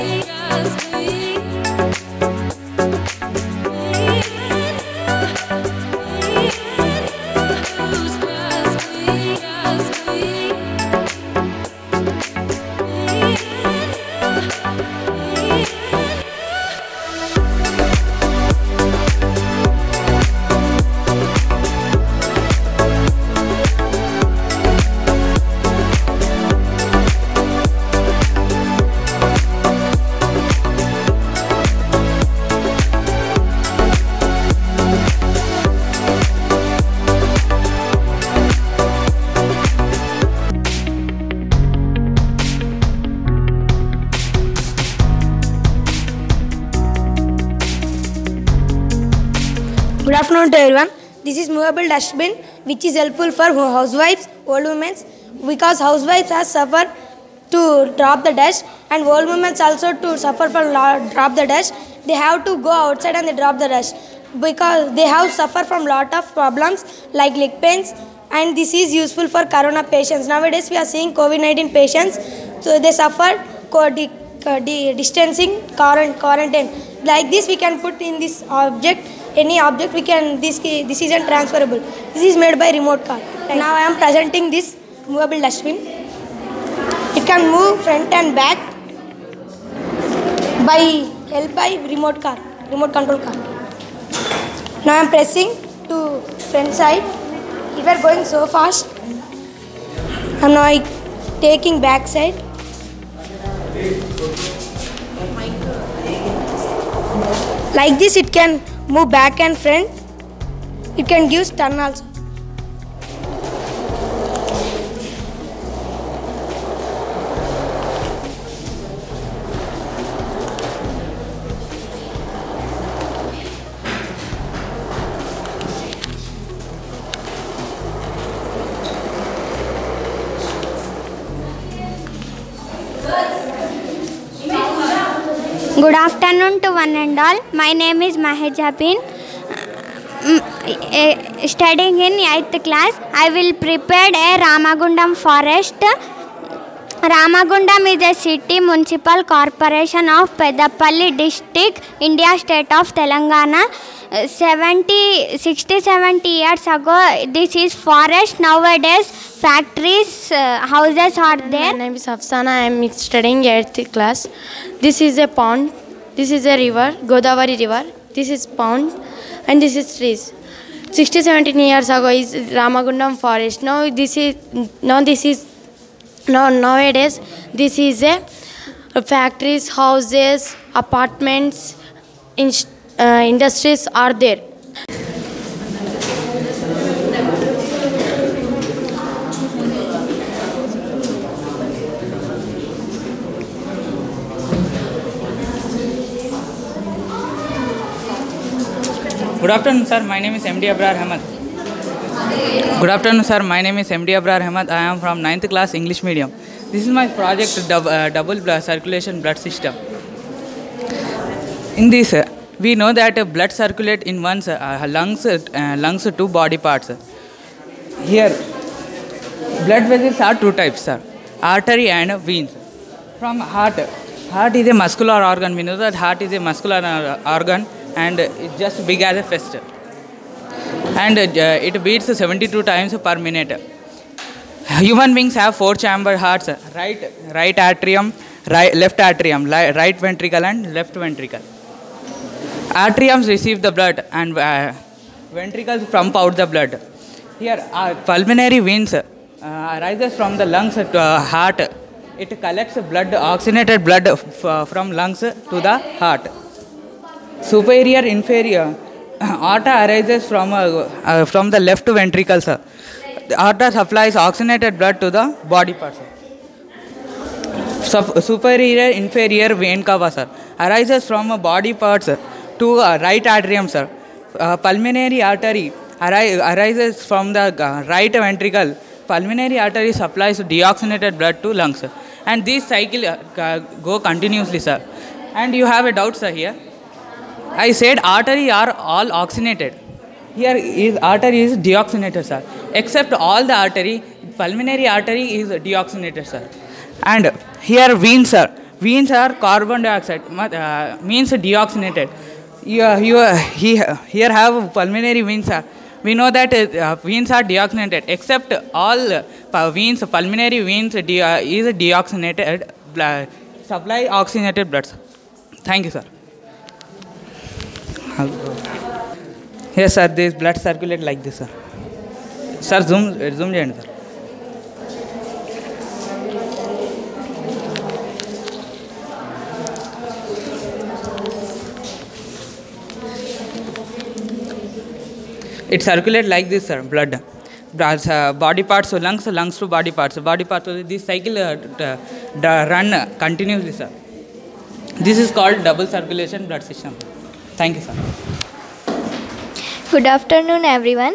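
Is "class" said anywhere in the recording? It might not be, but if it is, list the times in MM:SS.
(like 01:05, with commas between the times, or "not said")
02:43, 03:25.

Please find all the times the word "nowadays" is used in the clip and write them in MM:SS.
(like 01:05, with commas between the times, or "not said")
01:10, 02:38, 02:56.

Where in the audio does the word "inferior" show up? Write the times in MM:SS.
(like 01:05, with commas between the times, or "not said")
04:18, 04:29.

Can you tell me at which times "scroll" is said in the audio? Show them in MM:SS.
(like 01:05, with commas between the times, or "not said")
not said.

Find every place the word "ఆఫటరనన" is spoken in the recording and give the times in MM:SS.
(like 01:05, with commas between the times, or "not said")
02:16.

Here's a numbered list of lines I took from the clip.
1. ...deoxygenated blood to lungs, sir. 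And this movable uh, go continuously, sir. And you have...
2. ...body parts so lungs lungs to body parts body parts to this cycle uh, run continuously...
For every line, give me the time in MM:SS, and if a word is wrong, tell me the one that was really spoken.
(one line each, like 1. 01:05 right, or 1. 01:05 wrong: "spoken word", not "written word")
1. 04:40 wrong: "cycle", not "movable"
2. 05:38 right.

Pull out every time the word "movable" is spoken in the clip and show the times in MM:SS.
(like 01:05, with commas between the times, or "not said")
00:51, 01:25.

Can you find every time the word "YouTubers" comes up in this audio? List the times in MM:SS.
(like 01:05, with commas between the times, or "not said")
not said.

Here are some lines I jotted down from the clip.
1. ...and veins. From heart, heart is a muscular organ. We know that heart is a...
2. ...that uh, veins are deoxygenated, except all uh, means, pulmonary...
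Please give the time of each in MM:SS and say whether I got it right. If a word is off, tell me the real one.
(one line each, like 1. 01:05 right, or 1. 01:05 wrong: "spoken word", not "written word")
1. 03:41 right
2. 05:06 wrong: "veins", not "means".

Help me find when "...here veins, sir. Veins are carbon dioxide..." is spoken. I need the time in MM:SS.
04:57.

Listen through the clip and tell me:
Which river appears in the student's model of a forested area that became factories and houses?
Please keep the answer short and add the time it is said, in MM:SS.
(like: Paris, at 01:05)
Godavari, at 02:47.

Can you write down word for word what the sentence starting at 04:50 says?
Here is artery is deoxygenated, sir.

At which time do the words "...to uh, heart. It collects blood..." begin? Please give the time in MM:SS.
04:10.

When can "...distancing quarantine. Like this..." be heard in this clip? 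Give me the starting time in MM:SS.
01:14.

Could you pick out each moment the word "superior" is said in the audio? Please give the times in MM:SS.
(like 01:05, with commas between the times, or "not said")
04:17, 04:28.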